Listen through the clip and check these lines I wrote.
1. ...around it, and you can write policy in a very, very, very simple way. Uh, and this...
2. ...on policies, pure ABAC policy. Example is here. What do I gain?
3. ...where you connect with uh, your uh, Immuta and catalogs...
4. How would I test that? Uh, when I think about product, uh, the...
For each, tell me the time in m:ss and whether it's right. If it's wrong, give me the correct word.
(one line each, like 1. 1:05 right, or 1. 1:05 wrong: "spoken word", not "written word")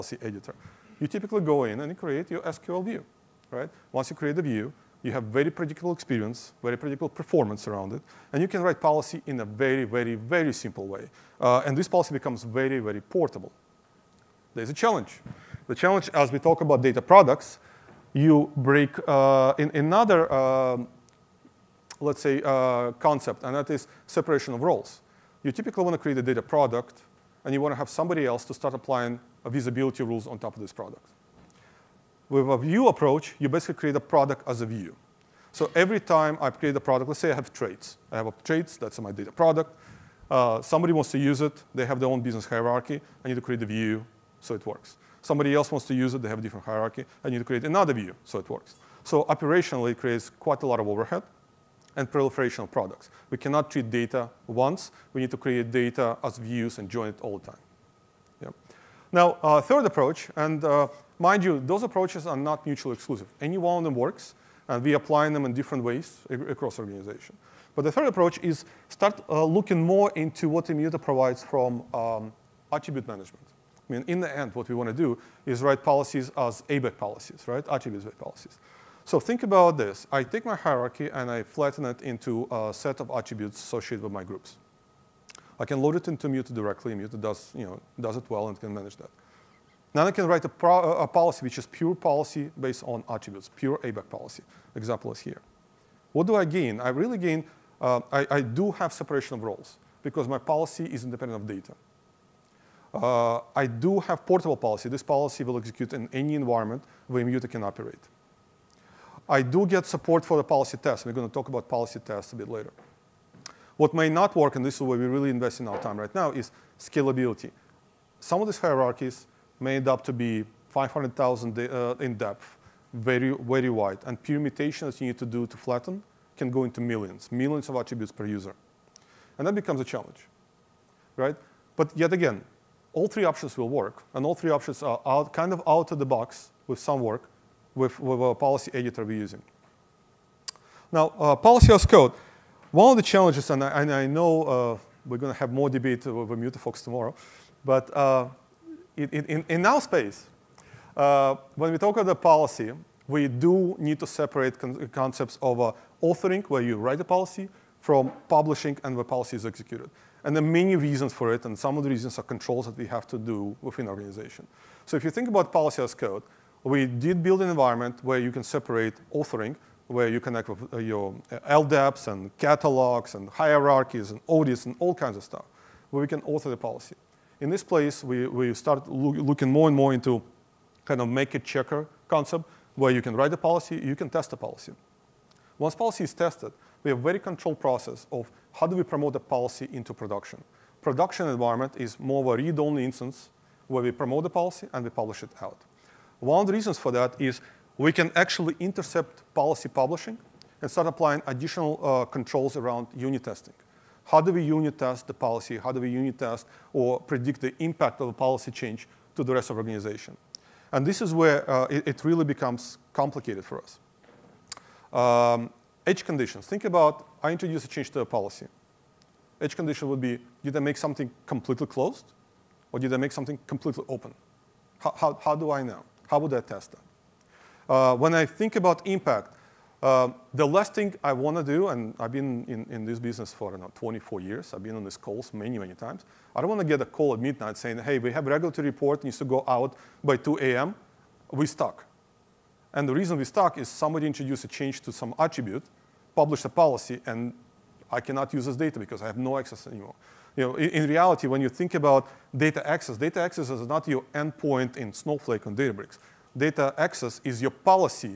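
1. 0:07 right
2. 1:32 wrong: "attributes", not "policies"
3. 2:49 wrong: "LDAPs", not "Immuta"
4. 3:46 wrong: "impact", not "product".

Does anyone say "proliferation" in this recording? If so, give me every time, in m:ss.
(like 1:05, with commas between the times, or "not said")
0:52.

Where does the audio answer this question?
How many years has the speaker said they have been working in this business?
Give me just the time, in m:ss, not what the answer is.
3:53.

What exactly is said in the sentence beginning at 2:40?
And there are many reasons for it, and some of the reasons are controls that we have to do within organization.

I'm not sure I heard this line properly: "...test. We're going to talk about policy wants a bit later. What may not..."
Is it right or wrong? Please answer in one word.
wrong.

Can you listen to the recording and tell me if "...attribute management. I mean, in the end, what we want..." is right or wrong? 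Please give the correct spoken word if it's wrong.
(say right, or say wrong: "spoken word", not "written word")
right.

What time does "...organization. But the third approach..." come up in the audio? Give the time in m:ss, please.
1:06.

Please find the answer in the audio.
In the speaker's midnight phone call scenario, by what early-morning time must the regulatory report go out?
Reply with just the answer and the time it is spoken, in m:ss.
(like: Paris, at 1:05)
2 a.m., at 4:00.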